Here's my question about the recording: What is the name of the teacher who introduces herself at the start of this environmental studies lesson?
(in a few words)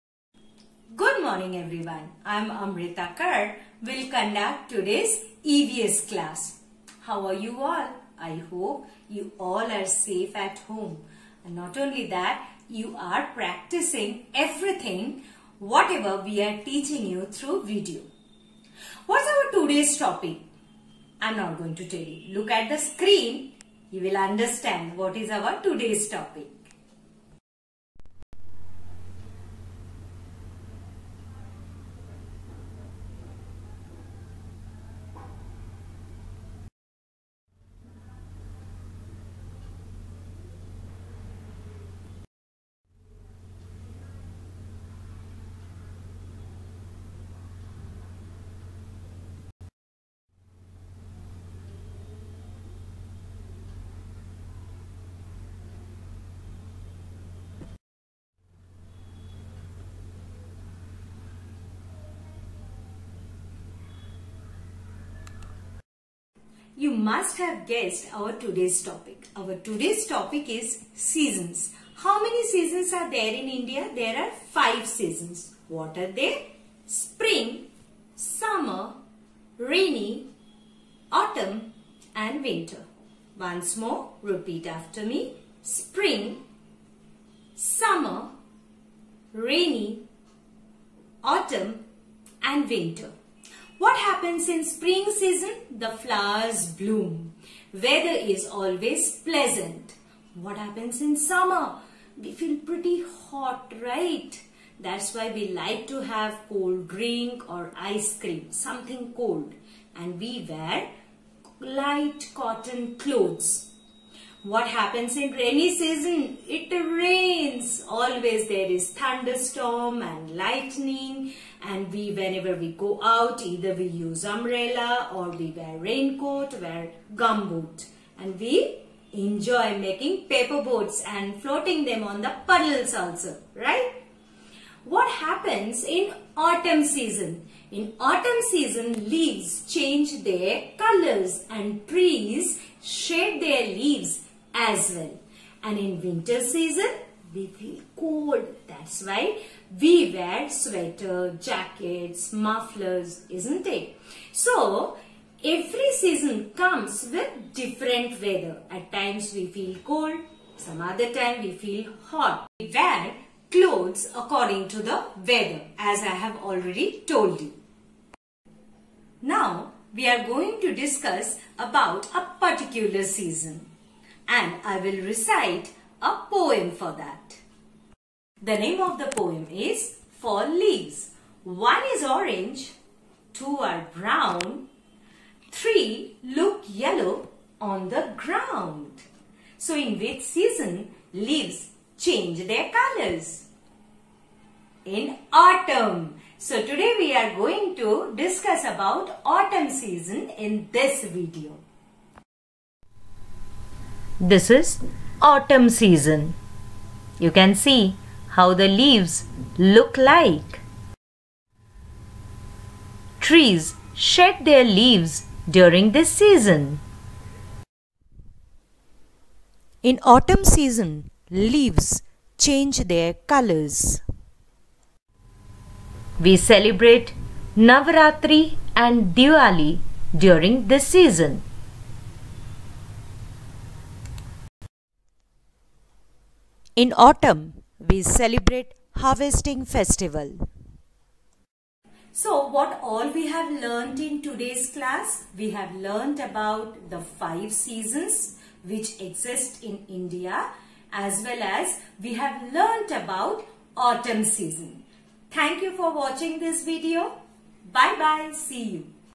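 Amrita Kar.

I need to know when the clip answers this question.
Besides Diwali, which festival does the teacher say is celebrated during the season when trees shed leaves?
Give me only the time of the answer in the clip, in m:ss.
3:47.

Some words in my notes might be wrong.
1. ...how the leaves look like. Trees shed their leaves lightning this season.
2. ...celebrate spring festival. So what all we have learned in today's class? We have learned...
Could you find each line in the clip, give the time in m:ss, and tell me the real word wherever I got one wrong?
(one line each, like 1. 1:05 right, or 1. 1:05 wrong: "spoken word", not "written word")
1. 3:28 wrong: "during", not "lightning"
2. 3:58 wrong: "harvesting", not "spring".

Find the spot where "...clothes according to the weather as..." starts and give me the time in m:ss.
2:43.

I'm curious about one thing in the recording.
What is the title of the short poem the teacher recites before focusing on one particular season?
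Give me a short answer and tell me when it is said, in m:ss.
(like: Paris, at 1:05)
Four Leaves, at 3:00.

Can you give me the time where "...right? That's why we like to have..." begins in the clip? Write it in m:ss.
1:43.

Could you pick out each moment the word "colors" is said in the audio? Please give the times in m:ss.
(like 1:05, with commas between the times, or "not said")
2:20, 3:12, 3:43.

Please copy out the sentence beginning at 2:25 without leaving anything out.
And in winter season, we feel cold.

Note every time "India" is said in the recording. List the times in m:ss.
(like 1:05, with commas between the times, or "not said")
1:13, 4:09.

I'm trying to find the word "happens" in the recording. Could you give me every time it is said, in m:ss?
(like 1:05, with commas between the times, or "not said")
1:33, 1:40, 1:54, 2:15.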